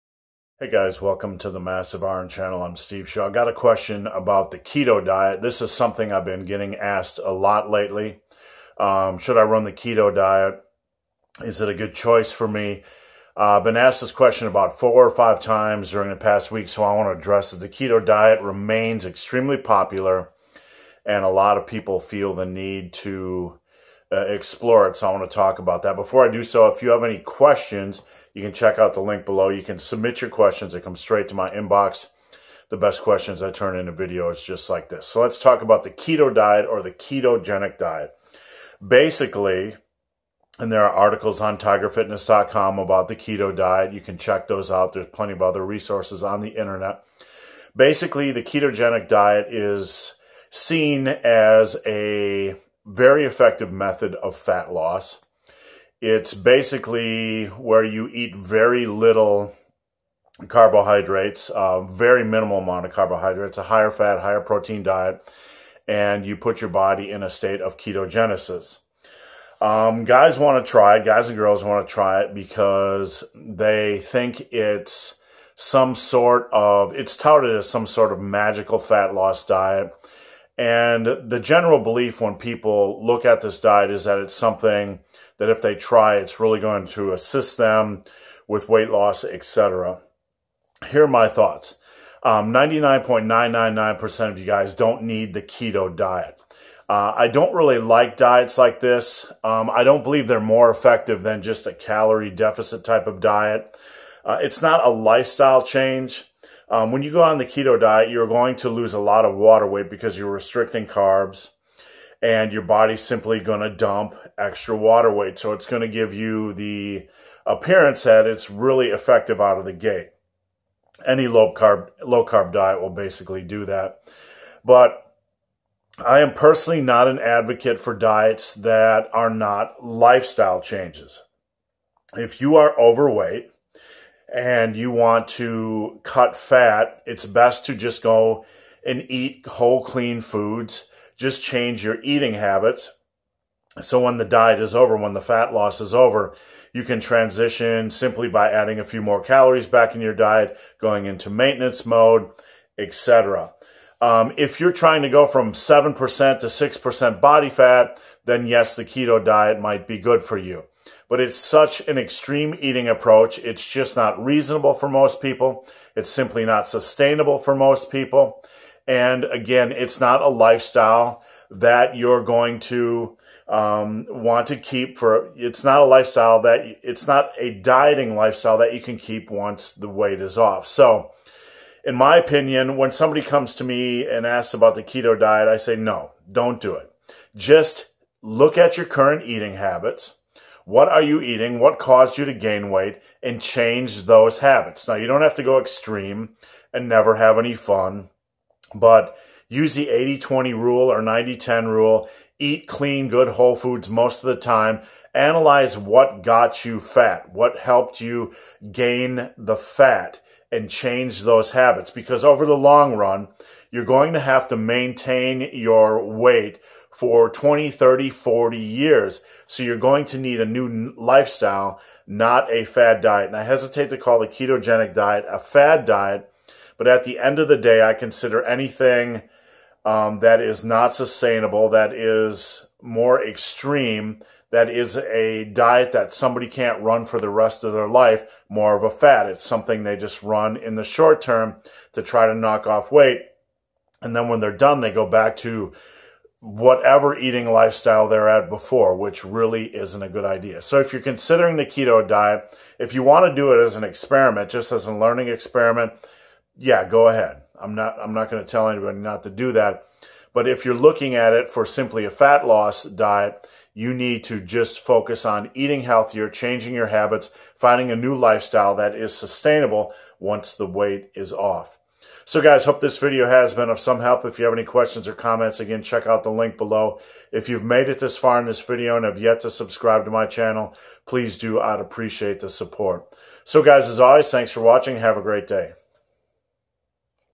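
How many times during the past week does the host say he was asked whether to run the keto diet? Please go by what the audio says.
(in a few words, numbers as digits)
4 or 5.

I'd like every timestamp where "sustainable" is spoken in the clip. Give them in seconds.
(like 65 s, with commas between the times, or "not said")
166 s, 230 s, 269 s.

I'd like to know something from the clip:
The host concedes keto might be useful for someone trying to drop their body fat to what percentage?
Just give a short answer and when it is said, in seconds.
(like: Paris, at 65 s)
6%, at 156 s.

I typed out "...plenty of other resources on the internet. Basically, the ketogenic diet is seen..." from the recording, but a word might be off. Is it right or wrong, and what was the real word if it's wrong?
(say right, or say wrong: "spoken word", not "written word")
right.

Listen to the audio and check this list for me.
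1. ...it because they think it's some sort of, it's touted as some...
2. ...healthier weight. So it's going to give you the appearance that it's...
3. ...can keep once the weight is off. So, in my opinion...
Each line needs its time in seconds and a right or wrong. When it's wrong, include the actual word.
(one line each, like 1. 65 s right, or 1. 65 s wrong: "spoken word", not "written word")
1. 72 s right
2. 114 s wrong: "water", not "healthier"
3. 178 s right.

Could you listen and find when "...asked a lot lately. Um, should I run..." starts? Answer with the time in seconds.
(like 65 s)
6 s.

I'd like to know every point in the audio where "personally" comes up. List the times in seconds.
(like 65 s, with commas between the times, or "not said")
126 s.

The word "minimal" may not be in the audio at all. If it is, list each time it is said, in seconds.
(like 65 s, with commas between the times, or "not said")
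62 s.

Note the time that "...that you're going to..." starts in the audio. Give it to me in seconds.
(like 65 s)
171 s.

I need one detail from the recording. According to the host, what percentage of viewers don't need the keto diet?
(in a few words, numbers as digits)
99.999%.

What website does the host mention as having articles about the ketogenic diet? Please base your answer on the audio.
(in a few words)
tigerfitness.com.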